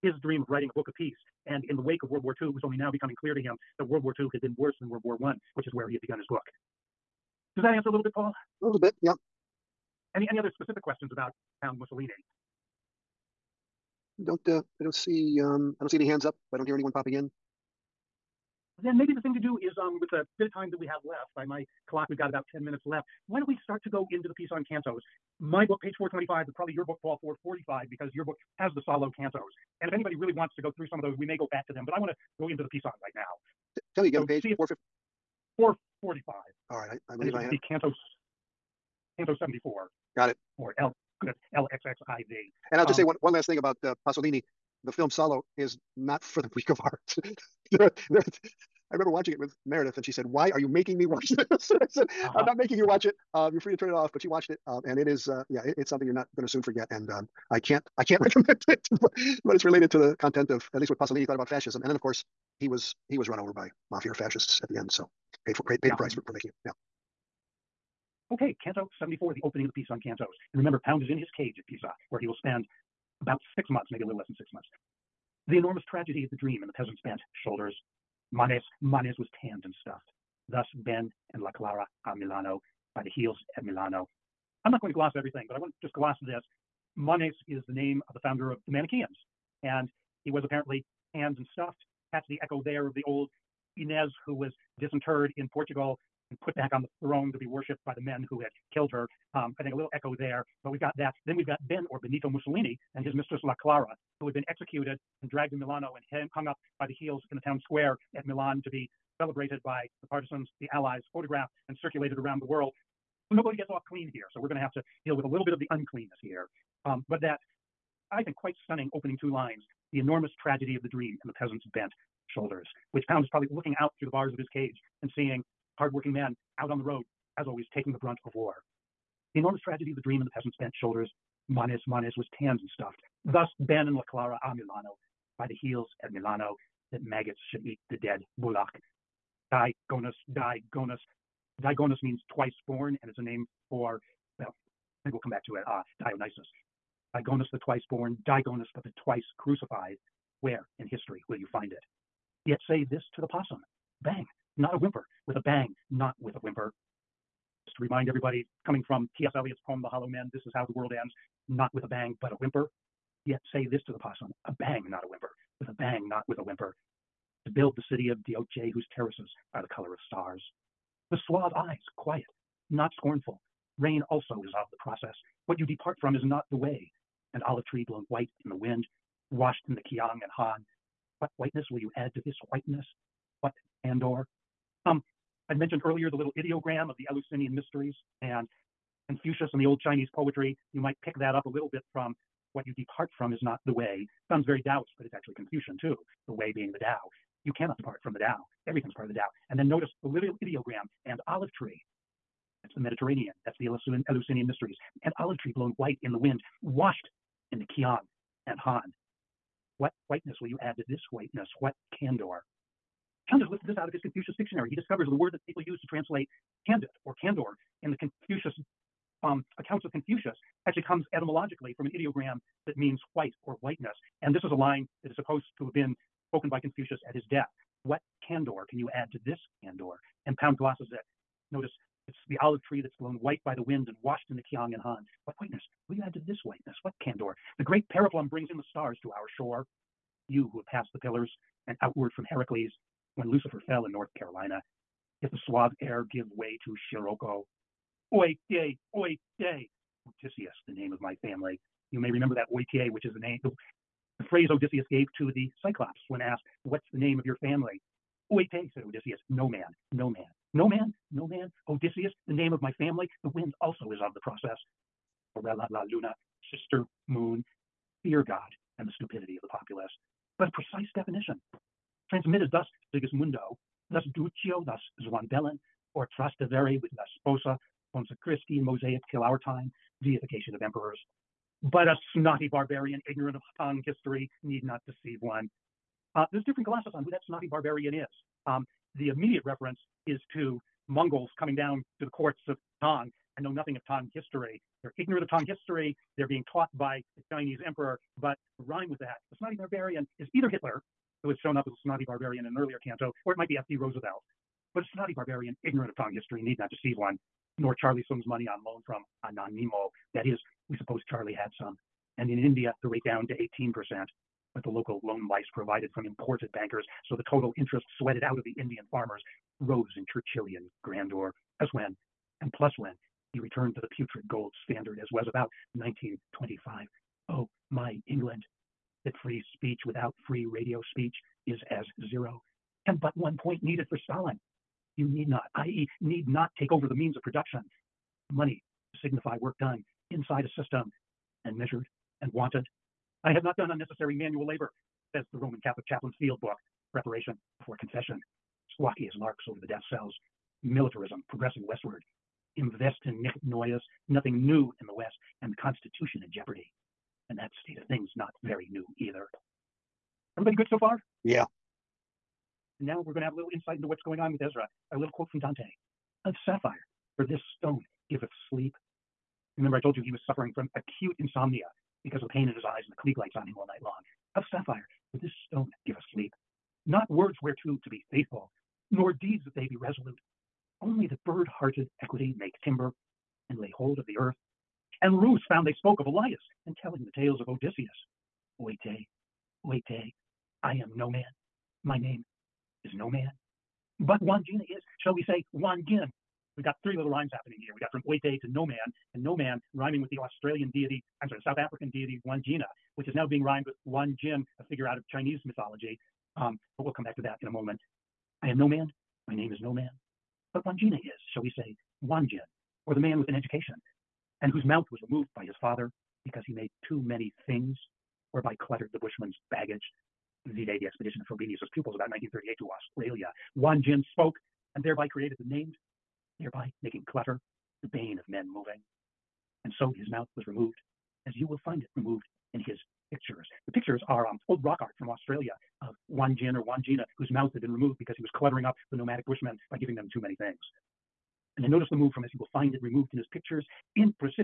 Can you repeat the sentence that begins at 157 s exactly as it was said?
Just to remind everybody, coming from T.S.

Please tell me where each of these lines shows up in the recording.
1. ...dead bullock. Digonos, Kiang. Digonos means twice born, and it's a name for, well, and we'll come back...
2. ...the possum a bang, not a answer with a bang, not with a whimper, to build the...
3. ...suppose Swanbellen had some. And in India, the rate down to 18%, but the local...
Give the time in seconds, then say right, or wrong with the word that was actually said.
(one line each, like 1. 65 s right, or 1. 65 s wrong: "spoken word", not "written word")
1. 138 s wrong: "Digonos", not "Kiang"
2. 163 s wrong: "whimper", not "answer"
3. 310 s wrong: "Charlie", not "Swanbellen".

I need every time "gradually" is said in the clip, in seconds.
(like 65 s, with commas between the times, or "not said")
not said.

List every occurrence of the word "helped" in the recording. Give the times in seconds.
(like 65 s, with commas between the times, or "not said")
not said.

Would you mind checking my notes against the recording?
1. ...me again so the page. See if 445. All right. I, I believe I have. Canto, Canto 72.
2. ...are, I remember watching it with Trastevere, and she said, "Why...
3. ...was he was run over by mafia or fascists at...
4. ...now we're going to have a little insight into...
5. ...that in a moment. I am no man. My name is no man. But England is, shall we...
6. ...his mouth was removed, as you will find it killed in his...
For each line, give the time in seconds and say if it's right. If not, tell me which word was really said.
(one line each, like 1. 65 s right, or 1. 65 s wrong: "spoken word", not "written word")
1. 34 s wrong: "74", not "72"
2. 47 s wrong: "Meredith", not "Trastevere"
3. 62 s right
4. 362 s right
5. 407 s wrong: "Wanjina", not "England"
6. 429 s wrong: "removed", not "killed".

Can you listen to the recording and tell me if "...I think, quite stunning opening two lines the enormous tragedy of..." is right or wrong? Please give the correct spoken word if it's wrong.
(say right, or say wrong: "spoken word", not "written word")
right.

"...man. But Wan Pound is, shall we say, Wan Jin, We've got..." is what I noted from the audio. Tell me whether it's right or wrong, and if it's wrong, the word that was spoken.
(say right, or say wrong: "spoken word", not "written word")
wrong: "Jin", not "Pound".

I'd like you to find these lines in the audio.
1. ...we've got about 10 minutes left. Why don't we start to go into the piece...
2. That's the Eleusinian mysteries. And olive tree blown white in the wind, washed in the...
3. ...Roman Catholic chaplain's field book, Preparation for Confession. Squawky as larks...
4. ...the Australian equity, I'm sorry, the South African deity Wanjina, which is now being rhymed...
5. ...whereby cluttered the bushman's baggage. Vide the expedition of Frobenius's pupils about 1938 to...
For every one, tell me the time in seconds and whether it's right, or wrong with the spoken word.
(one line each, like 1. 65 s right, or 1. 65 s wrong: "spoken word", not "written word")
1. 22 s right
2. 203 s right
3. 345 s right
4. 400 s wrong: "deity", not "equity"
5. 418 s right.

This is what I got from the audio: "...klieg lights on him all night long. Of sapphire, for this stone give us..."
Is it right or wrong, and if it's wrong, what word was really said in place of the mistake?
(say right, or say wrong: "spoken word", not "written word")
right.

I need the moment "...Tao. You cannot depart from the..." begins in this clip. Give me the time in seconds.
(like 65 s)
196 s.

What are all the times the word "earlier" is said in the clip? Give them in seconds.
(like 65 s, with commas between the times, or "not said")
185 s, 302 s.